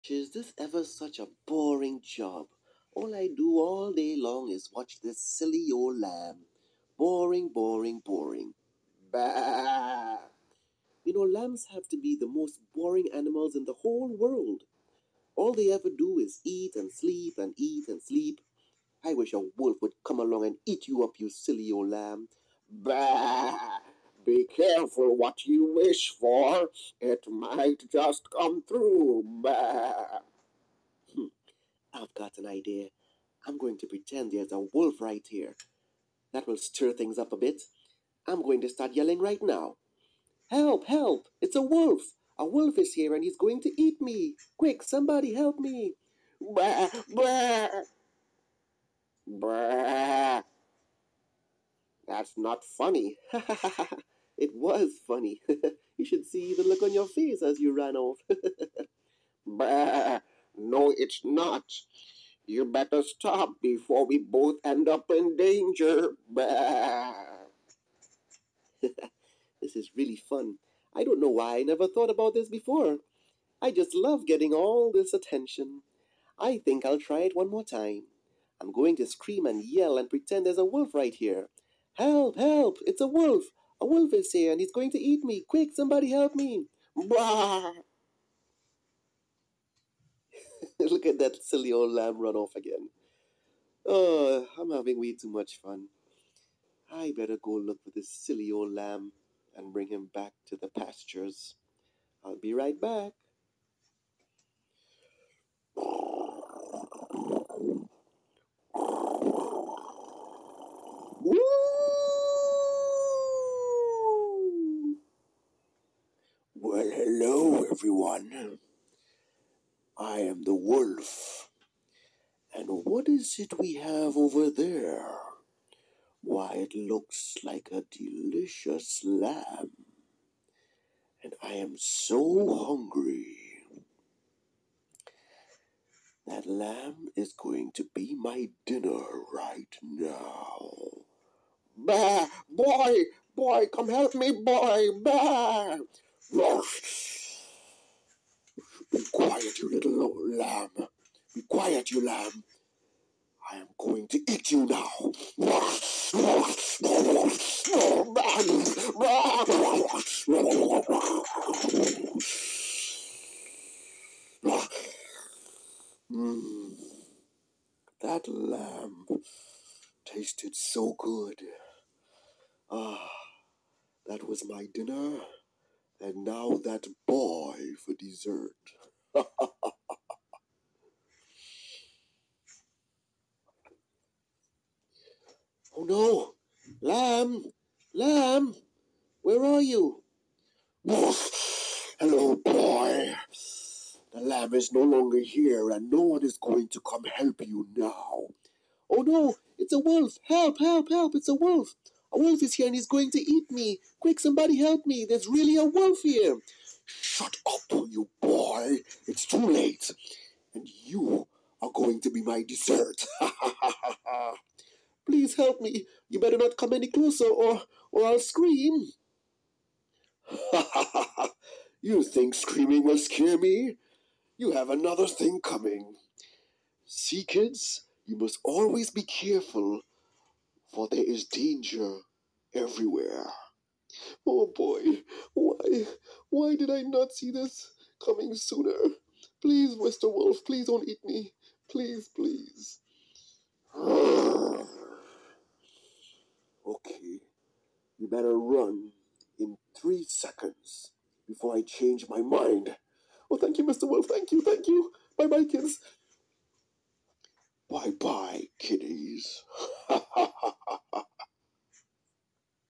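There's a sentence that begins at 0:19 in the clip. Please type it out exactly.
I wish a wolf would come along and eat you up, you silly old lamb.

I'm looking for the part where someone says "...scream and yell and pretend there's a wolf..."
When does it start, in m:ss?
1:19.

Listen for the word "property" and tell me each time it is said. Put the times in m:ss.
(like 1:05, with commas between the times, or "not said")
not said.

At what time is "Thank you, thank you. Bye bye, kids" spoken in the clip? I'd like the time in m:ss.
4:14.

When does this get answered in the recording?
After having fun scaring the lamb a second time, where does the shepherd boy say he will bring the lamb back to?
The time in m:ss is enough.
1:40.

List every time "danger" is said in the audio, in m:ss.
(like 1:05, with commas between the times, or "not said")
1:05, 3:51.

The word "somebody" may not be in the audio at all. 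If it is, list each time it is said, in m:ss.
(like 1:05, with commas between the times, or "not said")
0:44, 1:25, 3:24.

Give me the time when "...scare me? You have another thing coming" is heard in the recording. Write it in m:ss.
3:42.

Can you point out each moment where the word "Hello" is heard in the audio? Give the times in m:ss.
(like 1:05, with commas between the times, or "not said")
1:57, 3:10.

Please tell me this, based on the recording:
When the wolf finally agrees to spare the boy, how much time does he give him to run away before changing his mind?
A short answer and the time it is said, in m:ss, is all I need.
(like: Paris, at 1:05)
3 seconds, at 4:09.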